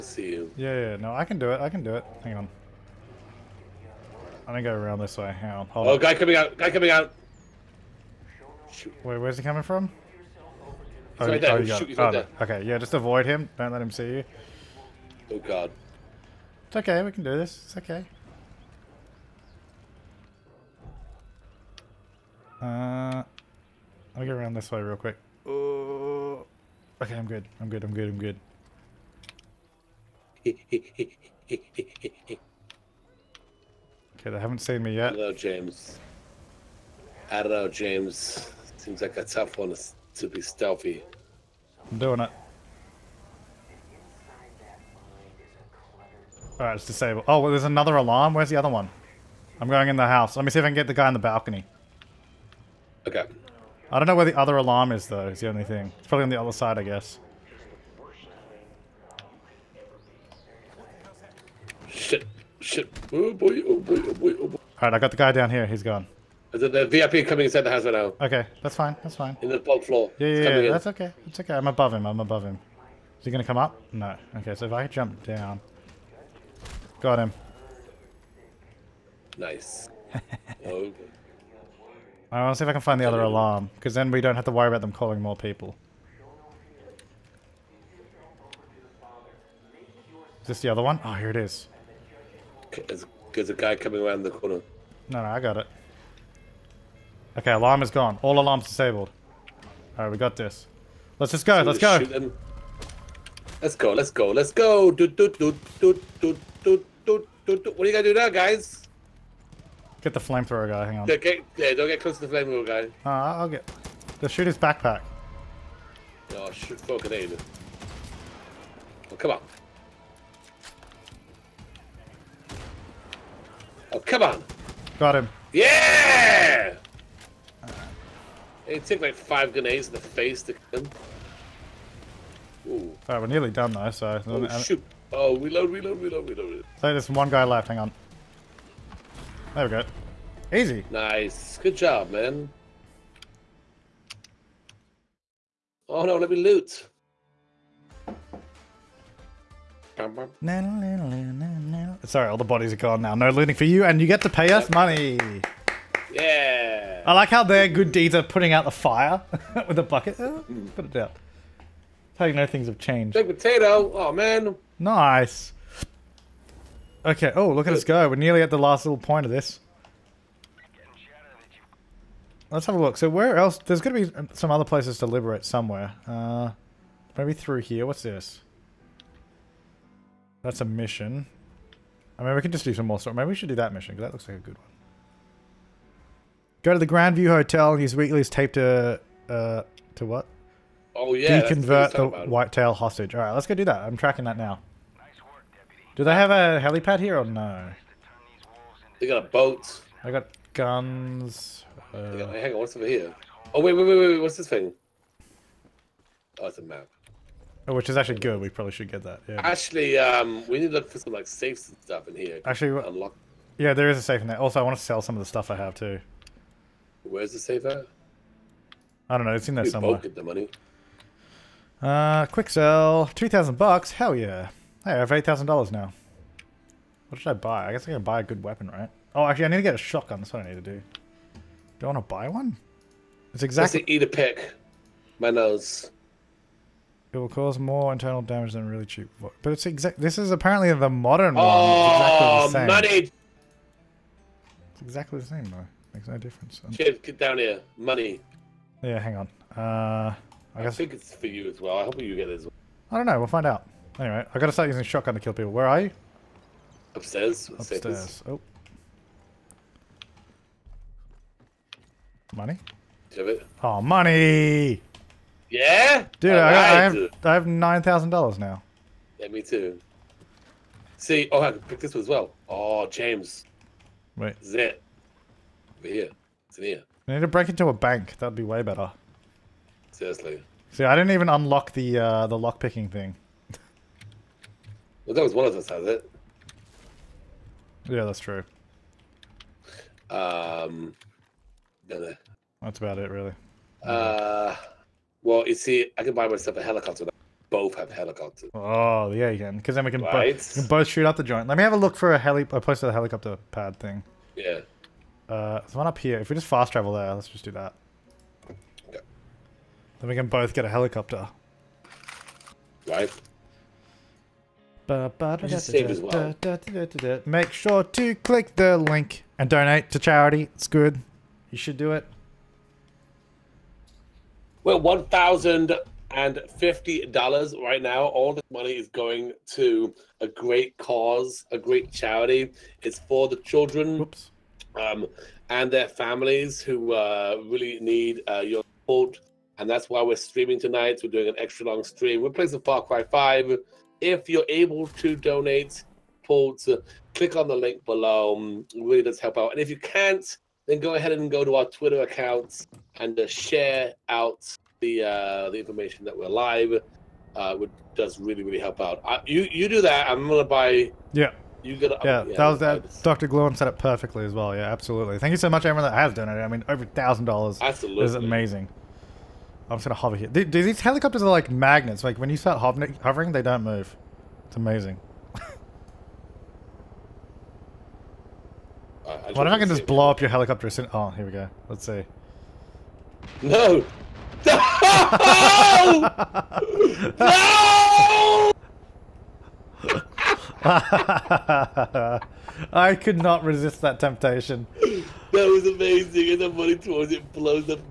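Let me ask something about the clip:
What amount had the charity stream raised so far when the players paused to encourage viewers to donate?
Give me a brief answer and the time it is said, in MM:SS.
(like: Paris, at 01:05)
$1,050, at 05:24.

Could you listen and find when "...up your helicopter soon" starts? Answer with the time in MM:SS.
06:20.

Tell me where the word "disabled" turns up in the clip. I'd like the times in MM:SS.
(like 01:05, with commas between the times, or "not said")
00:46, 01:38.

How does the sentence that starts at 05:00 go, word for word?
both, can both shoot out the joint.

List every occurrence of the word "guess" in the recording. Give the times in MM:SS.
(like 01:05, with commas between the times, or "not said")
00:56, 03:47.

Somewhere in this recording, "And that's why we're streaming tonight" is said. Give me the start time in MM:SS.
05:39.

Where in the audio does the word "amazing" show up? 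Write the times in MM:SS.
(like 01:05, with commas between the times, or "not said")
06:08, 06:14, 06:35.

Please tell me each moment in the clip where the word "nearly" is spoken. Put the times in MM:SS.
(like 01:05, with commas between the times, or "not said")
02:13, 02:48.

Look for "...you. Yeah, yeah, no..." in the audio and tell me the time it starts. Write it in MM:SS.
00:00.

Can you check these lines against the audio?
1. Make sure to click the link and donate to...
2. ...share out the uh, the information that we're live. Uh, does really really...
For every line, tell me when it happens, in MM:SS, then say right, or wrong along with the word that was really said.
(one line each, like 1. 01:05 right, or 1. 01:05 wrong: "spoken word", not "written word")
1. 05:14 right
2. 05:53 right.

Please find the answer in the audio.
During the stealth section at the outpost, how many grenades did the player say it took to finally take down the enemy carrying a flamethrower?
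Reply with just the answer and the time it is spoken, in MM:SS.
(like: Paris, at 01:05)
5, at 02:09.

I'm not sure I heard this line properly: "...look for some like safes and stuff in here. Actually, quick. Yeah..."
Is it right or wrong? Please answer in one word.
wrong.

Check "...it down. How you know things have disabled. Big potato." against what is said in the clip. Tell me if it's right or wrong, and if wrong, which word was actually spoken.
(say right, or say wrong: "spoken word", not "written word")
wrong: "changed", not "disabled".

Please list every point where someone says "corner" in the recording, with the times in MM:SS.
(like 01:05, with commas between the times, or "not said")
01:34.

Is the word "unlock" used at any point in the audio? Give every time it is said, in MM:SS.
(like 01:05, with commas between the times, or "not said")
03:32, 04:41.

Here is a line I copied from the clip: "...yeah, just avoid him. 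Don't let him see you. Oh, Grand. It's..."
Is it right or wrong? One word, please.
wrong.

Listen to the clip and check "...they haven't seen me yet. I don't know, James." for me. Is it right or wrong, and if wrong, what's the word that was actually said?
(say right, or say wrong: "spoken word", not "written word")
right.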